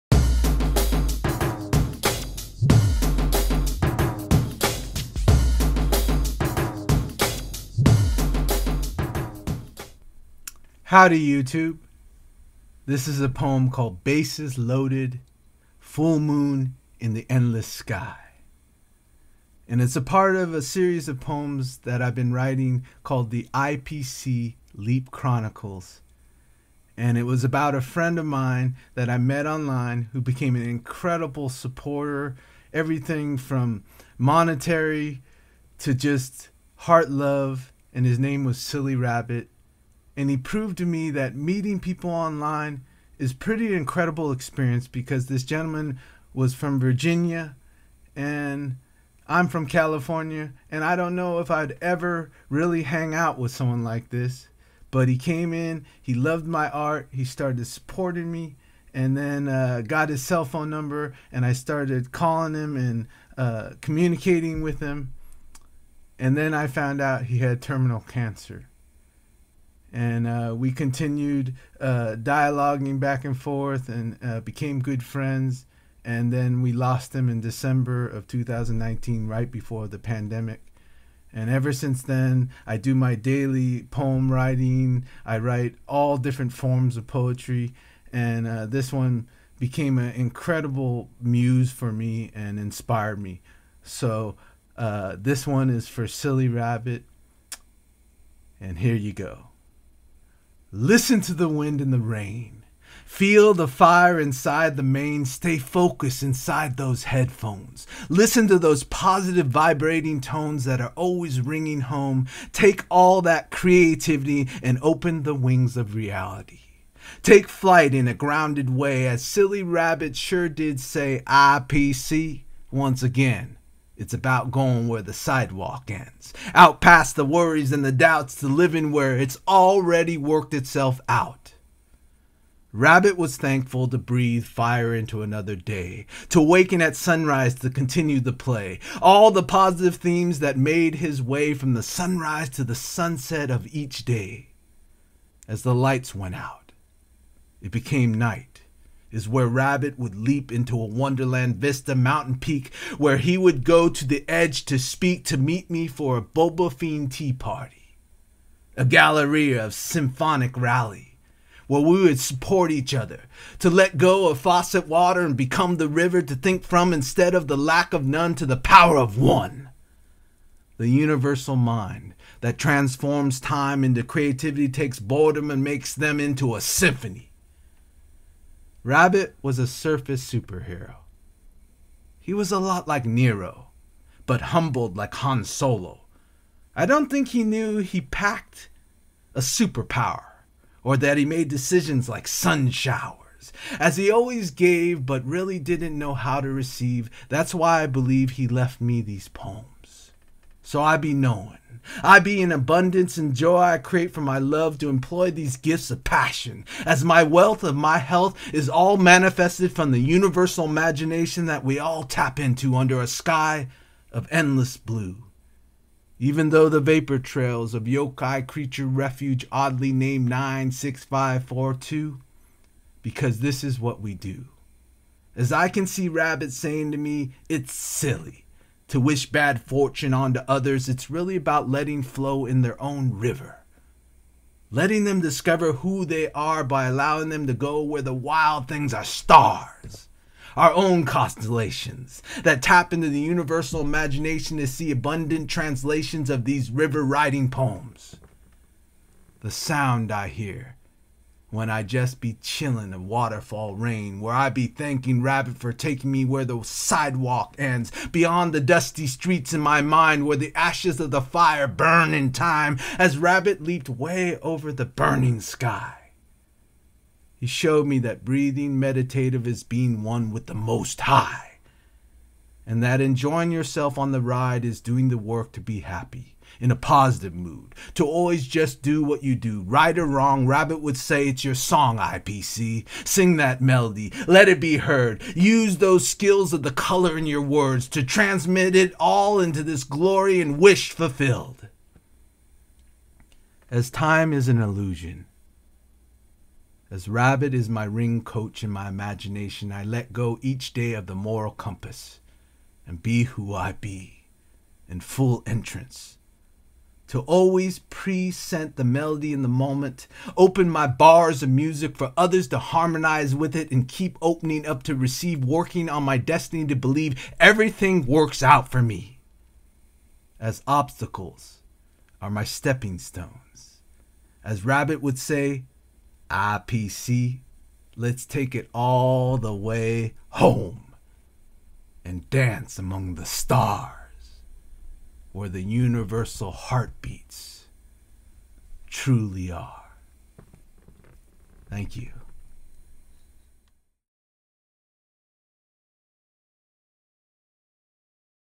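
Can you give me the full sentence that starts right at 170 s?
The universal mind that transforms time into creativity takes boredom and makes them into a symphony.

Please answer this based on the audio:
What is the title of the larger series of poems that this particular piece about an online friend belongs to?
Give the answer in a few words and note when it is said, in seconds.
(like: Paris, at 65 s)
IPC Leap Chronicles, at 23 s.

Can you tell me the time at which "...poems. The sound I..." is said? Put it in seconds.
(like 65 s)
247 s.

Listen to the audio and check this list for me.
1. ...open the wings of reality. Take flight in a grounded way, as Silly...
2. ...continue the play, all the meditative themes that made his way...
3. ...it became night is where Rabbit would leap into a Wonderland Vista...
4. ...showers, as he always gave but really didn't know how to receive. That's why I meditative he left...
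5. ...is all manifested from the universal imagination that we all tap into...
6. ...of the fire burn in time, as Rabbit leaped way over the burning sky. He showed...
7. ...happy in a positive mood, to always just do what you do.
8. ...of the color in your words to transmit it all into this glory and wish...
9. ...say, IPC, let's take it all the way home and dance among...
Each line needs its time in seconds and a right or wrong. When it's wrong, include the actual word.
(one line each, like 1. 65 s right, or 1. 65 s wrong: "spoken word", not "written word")
1. 114 s right
2. 137 s wrong: "positive", not "meditative"
3. 147 s right
4. 192 s wrong: "believe", not "meditative"
5. 208 s right
6. 261 s right
7. 275 s right
8. 286 s right
9. 325 s right.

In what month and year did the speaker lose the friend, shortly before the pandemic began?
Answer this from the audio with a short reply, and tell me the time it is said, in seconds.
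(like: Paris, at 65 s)
December 2019, at 77 s.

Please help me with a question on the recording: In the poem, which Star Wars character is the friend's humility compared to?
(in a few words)
Han Solo.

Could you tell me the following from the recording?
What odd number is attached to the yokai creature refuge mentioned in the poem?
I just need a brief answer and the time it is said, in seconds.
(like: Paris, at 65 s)
96542, at 220 s.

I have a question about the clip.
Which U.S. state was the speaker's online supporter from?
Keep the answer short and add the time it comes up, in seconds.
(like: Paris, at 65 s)
Virginia, at 46 s.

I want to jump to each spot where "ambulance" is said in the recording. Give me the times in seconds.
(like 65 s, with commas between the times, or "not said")
not said.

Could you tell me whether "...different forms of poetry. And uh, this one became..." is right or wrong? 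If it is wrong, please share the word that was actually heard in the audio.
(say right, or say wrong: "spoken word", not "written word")
right.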